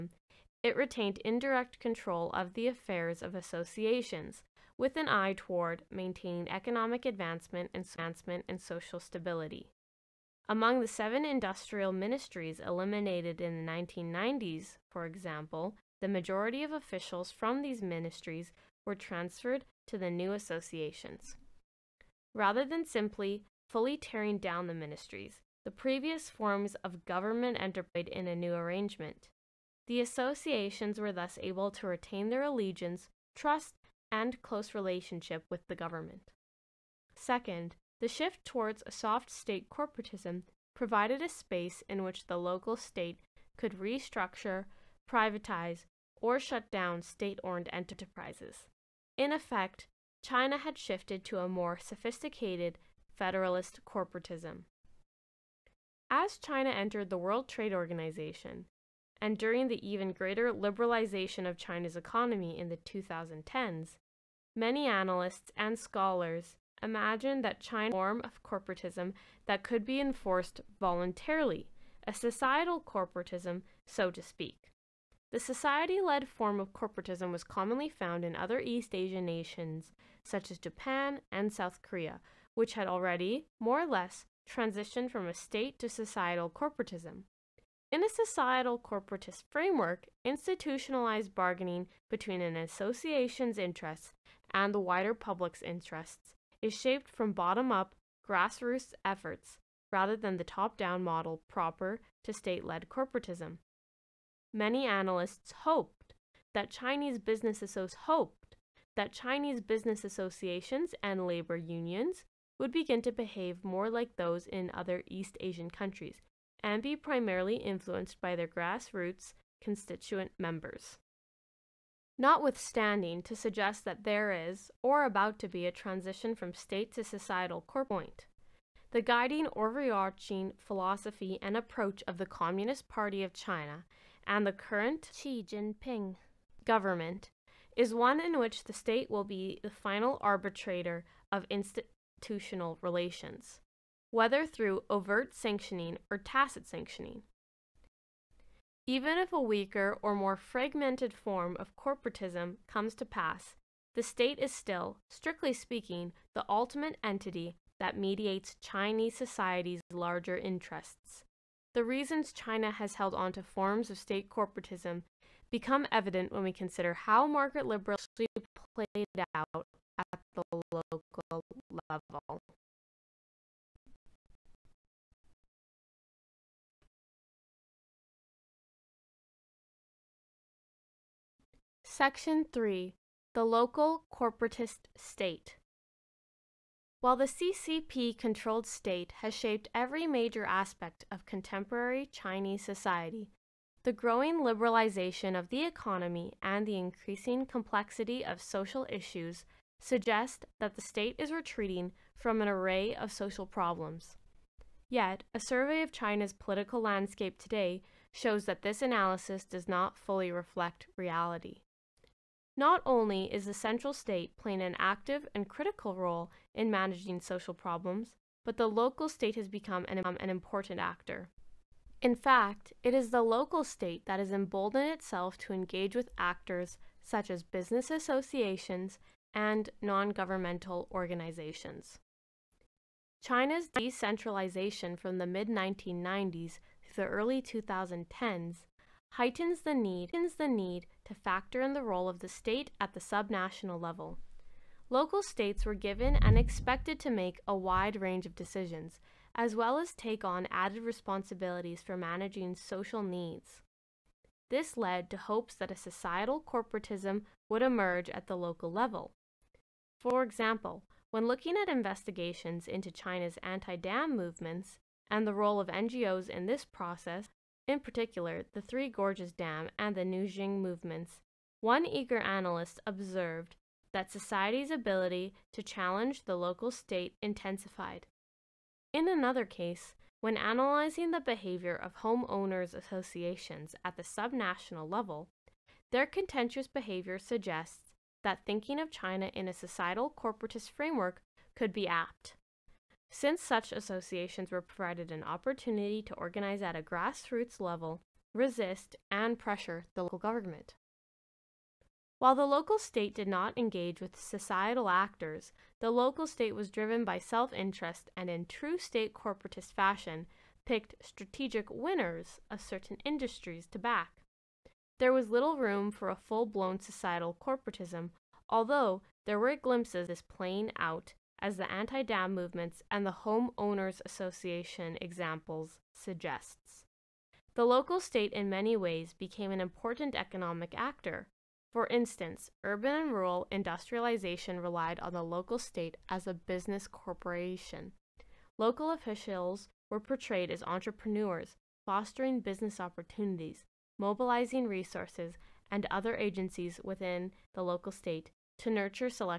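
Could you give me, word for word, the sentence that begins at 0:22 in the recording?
Rather than simply fully tearing down the ministries, the previous forms of government entered in a new arrangement.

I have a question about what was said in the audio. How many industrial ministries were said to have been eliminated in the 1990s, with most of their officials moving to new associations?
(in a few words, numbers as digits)
7.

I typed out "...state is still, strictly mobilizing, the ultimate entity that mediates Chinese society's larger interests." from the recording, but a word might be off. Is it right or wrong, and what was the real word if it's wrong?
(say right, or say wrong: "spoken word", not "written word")
wrong: "speaking", not "mobilizing".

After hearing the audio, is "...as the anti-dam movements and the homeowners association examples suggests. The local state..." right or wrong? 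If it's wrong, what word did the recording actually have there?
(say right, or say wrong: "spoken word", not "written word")
right.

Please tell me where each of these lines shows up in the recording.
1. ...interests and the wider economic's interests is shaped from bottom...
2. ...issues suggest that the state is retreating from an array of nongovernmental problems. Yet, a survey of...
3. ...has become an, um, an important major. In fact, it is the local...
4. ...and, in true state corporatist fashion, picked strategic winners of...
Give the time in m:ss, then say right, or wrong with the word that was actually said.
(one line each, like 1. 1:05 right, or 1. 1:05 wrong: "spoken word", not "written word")
1. 1:33 wrong: "public", not "economic"
2. 3:18 wrong: "social", not "nongovernmental"
3. 3:39 wrong: "actor", not "major"
4. 5:08 right.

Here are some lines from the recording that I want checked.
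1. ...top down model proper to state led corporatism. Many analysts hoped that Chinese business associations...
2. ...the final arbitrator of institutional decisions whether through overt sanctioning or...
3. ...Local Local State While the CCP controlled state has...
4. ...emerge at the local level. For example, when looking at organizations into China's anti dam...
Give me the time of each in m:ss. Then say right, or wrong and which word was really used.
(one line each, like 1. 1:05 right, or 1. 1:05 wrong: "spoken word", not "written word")
1. 1:40 right
2. 2:19 wrong: "relations", not "decisions"
3. 3:03 wrong: "Corporatist", not "Local"
4. 4:17 wrong: "investigations", not "organizations".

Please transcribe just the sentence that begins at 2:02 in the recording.
Notwithstanding, to suggest that there is, or about to be, a transition from state to societal core point.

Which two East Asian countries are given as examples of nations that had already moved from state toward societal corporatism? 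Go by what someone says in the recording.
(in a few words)
Japan and South Korea.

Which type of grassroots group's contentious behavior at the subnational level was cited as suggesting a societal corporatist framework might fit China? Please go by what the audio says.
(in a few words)
Homeowners associations.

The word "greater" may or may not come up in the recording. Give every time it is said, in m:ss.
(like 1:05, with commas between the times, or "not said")
1:00.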